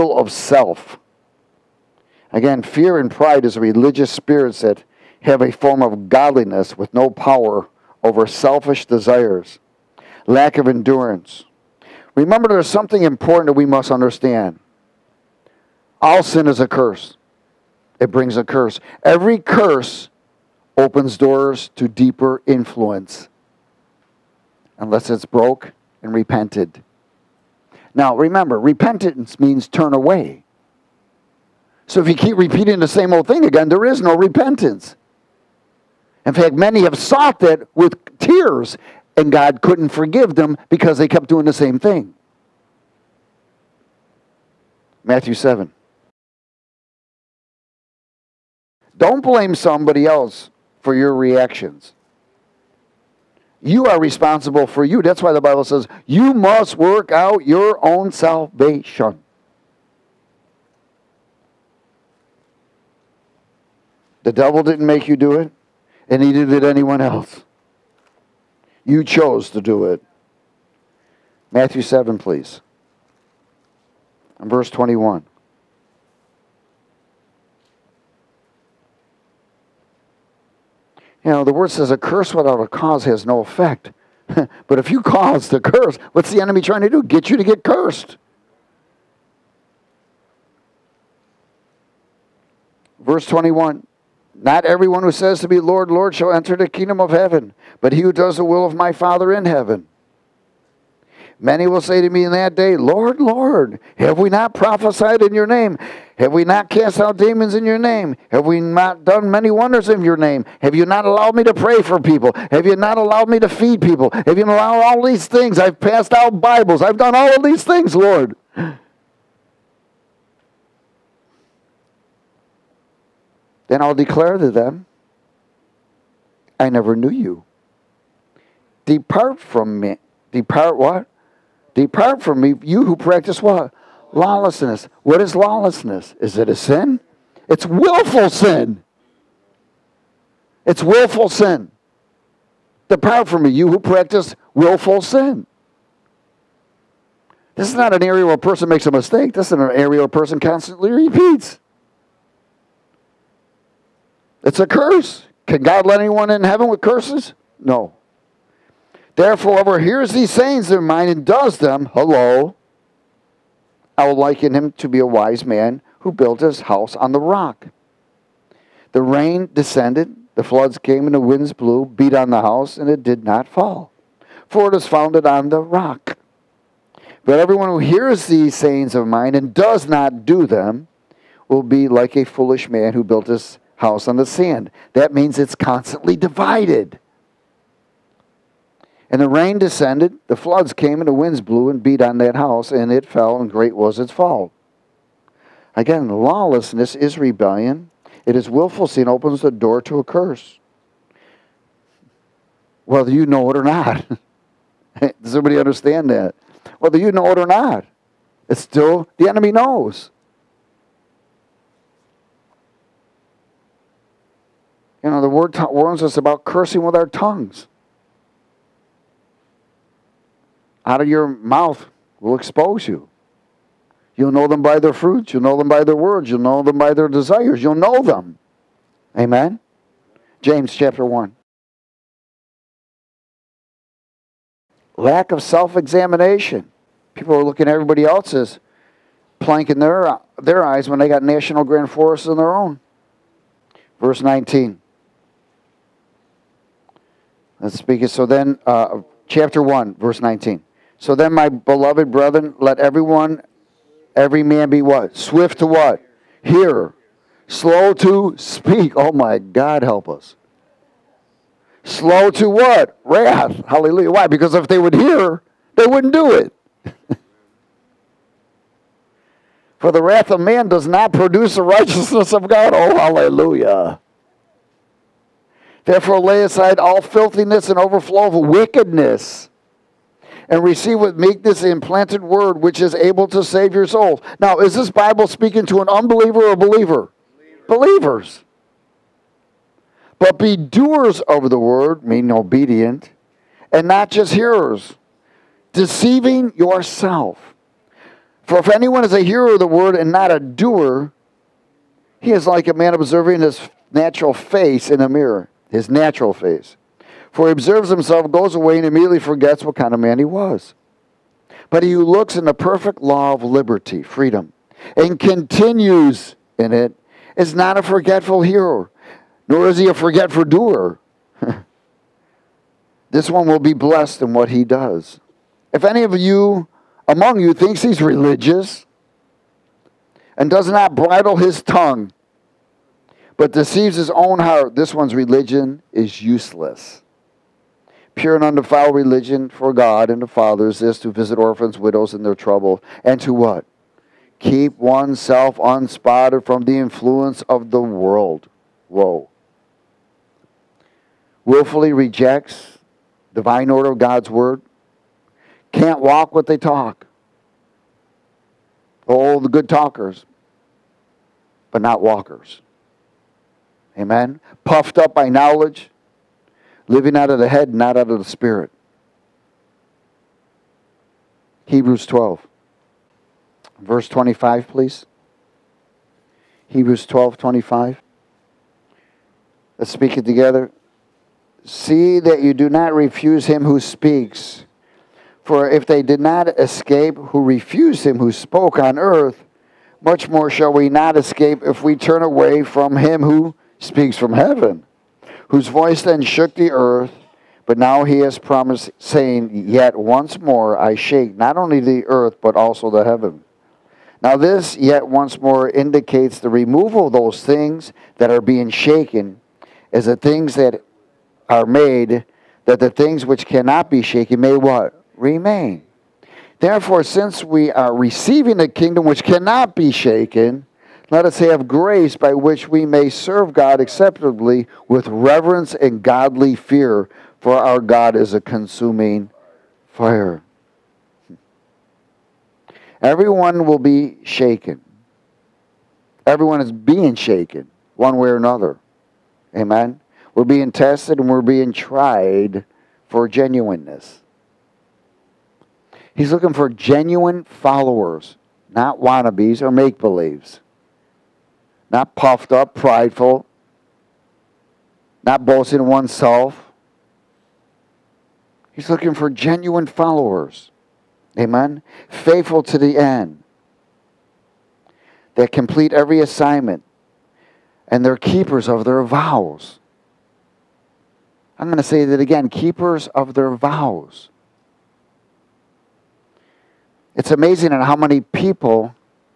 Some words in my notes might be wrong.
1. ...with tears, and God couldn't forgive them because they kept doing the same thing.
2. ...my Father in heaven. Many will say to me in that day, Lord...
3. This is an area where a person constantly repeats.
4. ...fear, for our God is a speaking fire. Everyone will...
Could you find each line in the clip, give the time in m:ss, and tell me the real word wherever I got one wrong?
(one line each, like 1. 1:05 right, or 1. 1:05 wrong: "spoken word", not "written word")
1. 0:37 right
2. 1:38 right
3. 2:29 right
4. 7:06 wrong: "consuming", not "speaking".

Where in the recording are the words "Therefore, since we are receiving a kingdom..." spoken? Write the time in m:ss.
6:56.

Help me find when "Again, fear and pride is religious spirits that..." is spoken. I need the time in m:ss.
0:02.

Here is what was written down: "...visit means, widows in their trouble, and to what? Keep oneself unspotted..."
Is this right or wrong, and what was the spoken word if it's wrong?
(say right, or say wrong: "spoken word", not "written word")
wrong: "orphans", not "means".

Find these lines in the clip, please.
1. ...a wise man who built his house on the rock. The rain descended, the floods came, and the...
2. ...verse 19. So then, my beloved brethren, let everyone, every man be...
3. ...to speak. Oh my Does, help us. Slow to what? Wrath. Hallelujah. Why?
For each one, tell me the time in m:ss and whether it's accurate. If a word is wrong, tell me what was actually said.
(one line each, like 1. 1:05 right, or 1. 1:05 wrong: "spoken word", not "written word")
1. 2:44 right
2. 4:09 right
3. 4:17 wrong: "God", not "Does".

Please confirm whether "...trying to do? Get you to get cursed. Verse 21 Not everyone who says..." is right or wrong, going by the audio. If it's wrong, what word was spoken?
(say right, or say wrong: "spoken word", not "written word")
right.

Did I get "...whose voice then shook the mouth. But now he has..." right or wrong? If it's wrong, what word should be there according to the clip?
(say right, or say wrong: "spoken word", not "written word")
wrong: "earth", not "mouth".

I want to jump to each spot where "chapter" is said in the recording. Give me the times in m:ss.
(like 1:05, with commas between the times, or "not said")
3:50, 4:09.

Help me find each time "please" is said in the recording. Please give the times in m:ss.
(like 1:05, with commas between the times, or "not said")
1:12, 6:14.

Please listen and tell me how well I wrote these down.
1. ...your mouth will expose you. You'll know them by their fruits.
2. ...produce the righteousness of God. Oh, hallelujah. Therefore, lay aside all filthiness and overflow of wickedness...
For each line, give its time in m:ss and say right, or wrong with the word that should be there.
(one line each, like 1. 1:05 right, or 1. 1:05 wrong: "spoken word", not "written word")
1. 3:41 right
2. 4:31 right.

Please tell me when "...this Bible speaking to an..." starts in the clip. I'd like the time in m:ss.
4:44.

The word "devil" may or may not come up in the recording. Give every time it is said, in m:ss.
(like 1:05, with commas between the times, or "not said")
1:04.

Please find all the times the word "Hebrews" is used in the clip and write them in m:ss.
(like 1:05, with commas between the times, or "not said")
6:11, 6:16.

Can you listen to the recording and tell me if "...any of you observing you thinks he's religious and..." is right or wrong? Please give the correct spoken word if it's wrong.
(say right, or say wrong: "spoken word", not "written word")
wrong: "among", not "observing".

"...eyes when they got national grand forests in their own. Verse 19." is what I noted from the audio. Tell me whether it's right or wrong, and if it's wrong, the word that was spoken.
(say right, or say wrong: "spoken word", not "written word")
right.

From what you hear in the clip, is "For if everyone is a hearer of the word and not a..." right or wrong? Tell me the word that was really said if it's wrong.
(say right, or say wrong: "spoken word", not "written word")
wrong: "anyone", not "everyone".